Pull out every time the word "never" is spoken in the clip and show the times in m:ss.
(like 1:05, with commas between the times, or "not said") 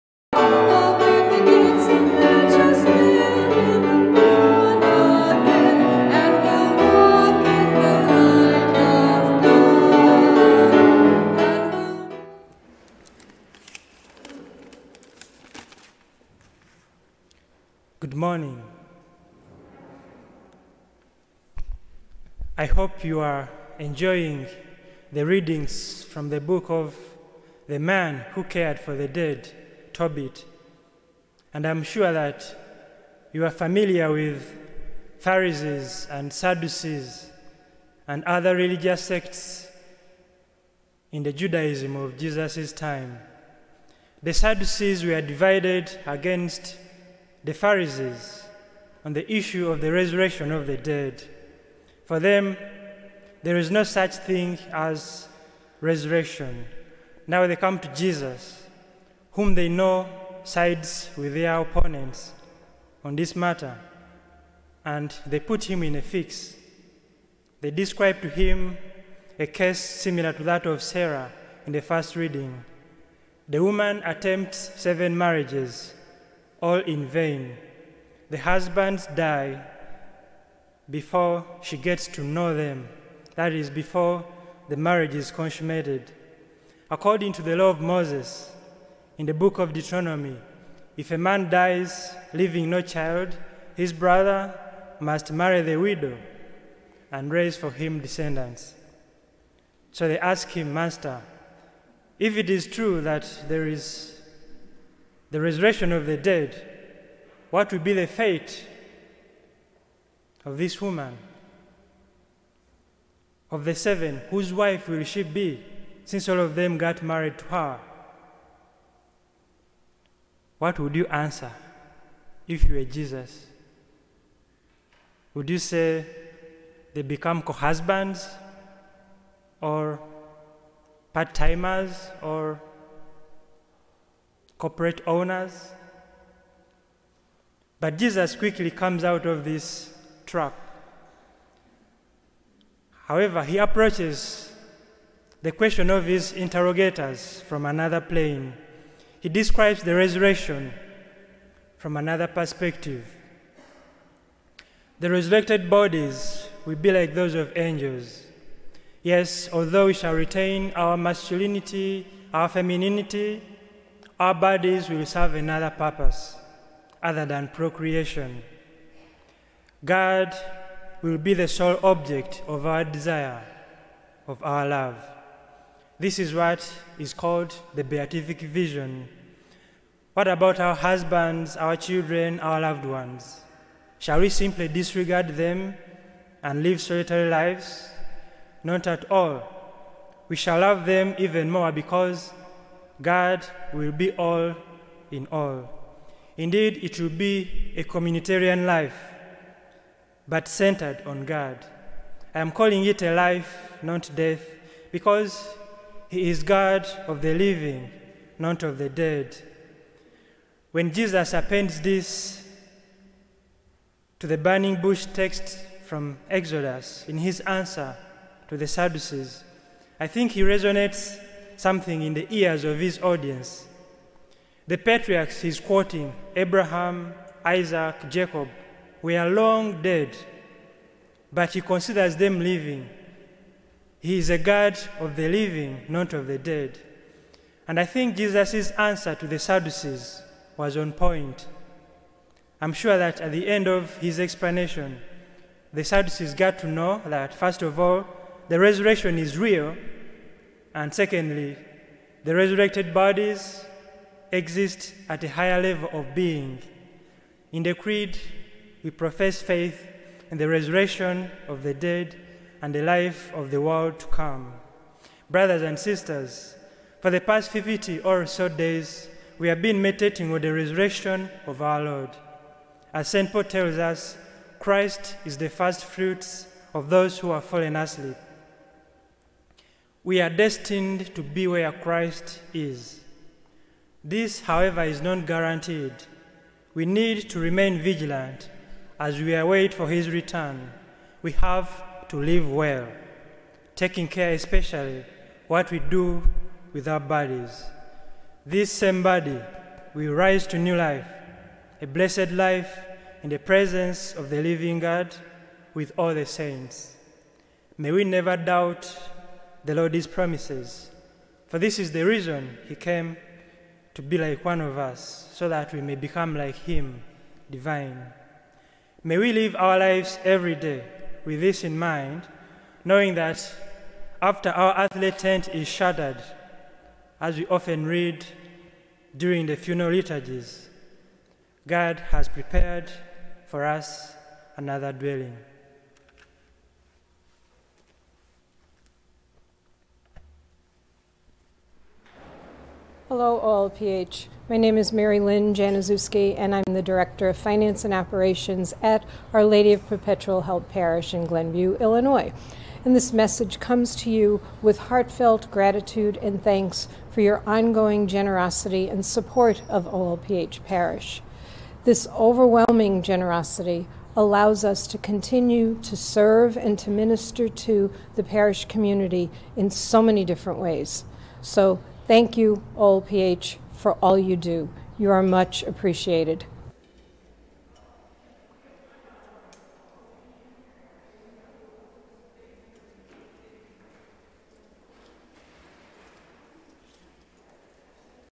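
5:08.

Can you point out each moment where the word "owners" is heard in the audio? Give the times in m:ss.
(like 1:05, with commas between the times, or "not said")
2:15.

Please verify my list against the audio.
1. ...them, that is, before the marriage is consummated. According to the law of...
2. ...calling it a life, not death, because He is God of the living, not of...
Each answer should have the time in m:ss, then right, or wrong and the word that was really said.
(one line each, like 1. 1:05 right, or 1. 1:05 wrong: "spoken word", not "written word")
1. 1:22 right
2. 3:22 right.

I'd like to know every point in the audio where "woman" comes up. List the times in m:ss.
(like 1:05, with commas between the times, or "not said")
1:13, 1:50.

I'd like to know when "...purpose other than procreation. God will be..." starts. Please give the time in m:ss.
2:45.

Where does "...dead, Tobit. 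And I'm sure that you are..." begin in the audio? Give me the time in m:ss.
0:29.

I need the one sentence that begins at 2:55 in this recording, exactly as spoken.
This is what is called the beatific vision.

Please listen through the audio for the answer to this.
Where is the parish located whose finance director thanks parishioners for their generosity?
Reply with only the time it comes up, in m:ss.
5:51.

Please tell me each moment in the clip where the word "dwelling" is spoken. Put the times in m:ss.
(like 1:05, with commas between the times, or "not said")
5:34.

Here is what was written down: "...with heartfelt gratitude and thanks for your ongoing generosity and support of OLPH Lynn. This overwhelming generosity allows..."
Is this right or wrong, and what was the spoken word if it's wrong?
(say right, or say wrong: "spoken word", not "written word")
wrong: "Parish", not "Lynn".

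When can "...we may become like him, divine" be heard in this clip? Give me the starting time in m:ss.
5:15.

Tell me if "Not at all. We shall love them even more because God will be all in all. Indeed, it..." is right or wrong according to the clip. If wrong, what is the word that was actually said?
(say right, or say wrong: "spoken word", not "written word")
right.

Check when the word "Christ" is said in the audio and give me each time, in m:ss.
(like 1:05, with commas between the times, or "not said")
4:34, 4:41.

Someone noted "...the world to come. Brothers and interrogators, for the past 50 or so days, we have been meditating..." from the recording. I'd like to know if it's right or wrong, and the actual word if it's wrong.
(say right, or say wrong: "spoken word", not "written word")
wrong: "sisters", not "interrogators".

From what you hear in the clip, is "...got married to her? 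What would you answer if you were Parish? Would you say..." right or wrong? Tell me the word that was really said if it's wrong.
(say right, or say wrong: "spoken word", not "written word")
wrong: "Jesus", not "Parish".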